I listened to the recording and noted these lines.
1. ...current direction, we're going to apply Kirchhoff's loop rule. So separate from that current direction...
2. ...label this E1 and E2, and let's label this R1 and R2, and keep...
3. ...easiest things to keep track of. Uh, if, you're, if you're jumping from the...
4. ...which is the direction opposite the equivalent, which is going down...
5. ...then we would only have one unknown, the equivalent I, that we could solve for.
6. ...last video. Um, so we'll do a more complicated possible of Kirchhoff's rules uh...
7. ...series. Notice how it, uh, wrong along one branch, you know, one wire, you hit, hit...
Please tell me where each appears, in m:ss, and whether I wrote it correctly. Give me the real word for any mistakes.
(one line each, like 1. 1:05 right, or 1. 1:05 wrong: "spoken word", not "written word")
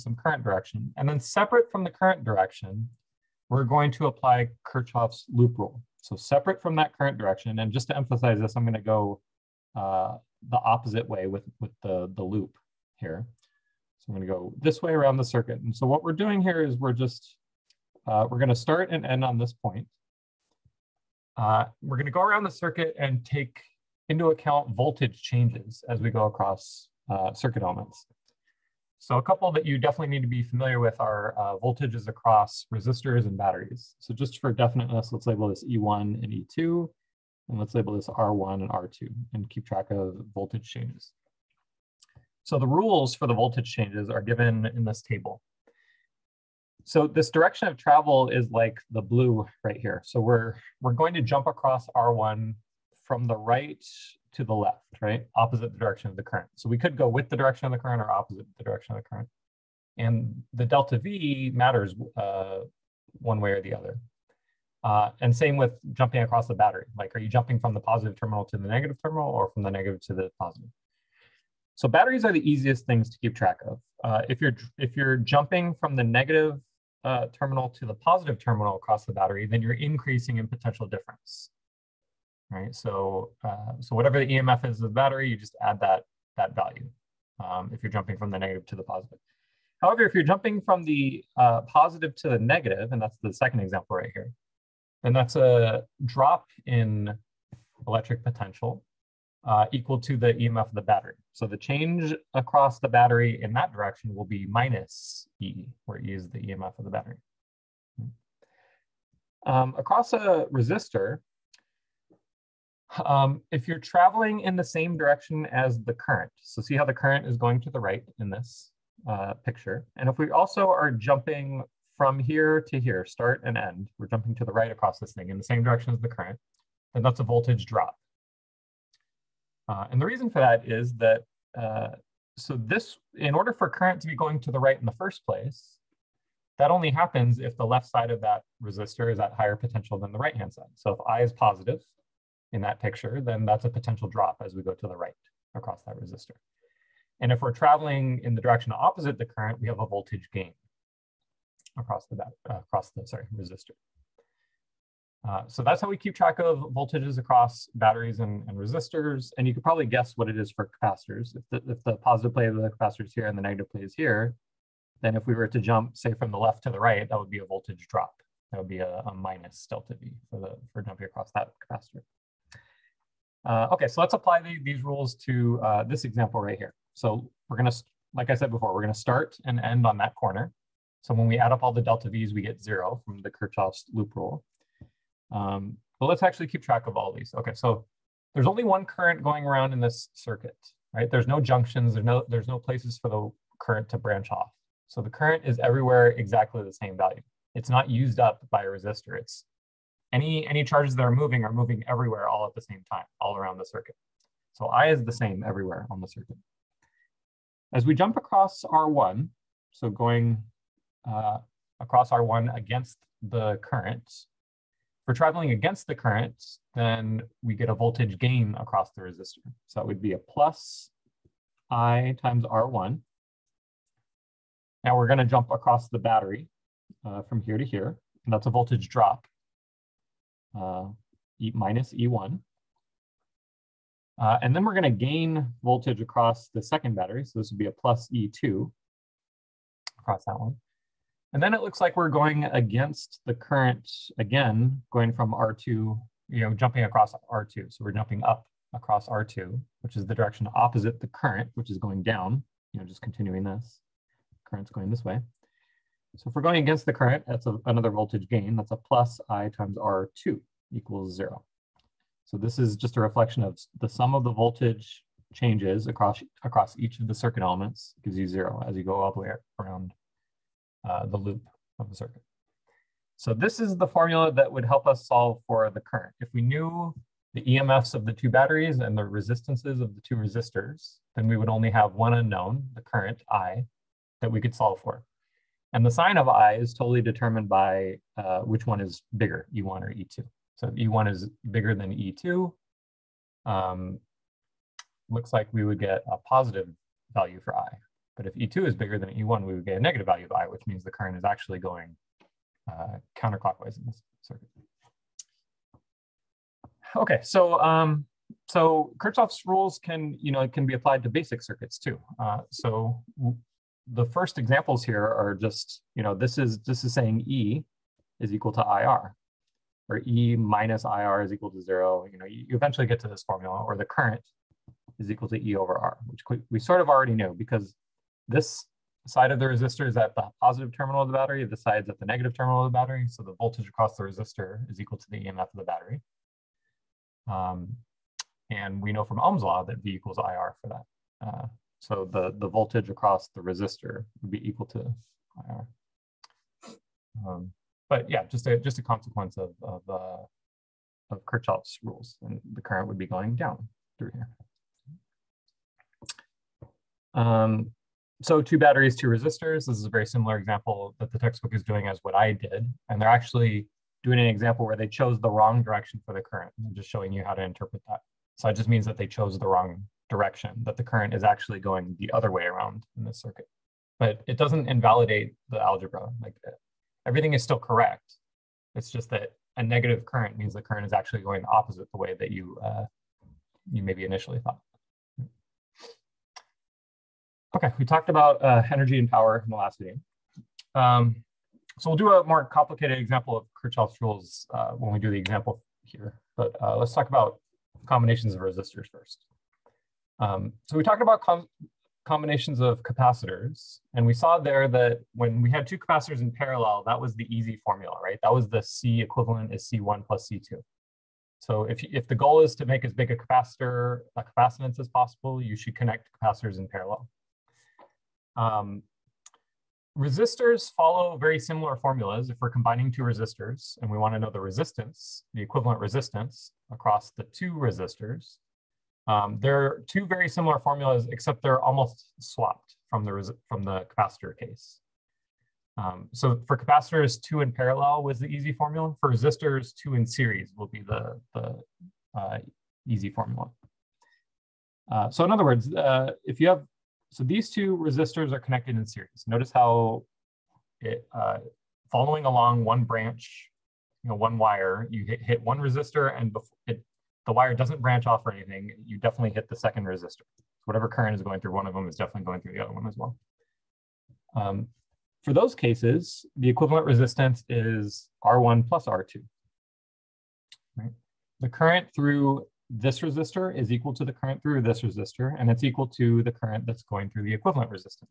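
1. 0:01 right
2. 0:35 right
3. 1:12 right
4. 4:09 wrong: "current", not "equivalent"
5. 4:41 wrong: "current", not "equivalent"
6. 6:29 wrong: "example", not "possible"
7. 7:28 wrong: "following", not "wrong".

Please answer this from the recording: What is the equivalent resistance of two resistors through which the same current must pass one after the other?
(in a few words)
R1 plus R2.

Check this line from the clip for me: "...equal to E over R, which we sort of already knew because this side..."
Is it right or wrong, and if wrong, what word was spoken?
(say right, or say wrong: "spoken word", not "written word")
right.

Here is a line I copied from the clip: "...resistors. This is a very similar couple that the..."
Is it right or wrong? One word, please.
wrong.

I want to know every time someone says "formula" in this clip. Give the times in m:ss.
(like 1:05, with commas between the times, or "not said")
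4:33, 5:23, 6:47, 7:01, 7:10, 7:18, 7:23.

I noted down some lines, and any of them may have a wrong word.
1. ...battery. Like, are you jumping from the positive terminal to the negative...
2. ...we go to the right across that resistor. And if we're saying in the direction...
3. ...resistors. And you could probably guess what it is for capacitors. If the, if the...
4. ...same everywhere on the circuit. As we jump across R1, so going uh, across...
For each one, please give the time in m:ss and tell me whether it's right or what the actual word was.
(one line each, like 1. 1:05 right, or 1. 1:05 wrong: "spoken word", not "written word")
1. 1:06 right
2. 2:24 wrong: "traveling", not "saying"
3. 2:38 right
4. 3:25 right.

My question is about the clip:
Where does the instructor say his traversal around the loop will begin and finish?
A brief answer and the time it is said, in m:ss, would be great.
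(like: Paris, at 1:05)
that corner, at 2:59.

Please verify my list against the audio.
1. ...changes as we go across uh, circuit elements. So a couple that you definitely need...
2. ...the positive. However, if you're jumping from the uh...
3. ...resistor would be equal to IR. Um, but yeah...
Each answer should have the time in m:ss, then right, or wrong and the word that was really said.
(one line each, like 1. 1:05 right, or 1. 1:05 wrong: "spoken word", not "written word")
1. 0:25 right
2. 1:28 right
3. 5:43 right.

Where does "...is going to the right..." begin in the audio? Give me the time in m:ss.
1:57.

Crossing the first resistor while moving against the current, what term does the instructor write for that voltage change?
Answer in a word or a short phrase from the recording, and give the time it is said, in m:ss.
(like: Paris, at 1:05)
plus I times R1, at 3:40.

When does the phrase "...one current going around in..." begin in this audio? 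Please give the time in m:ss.
3:08.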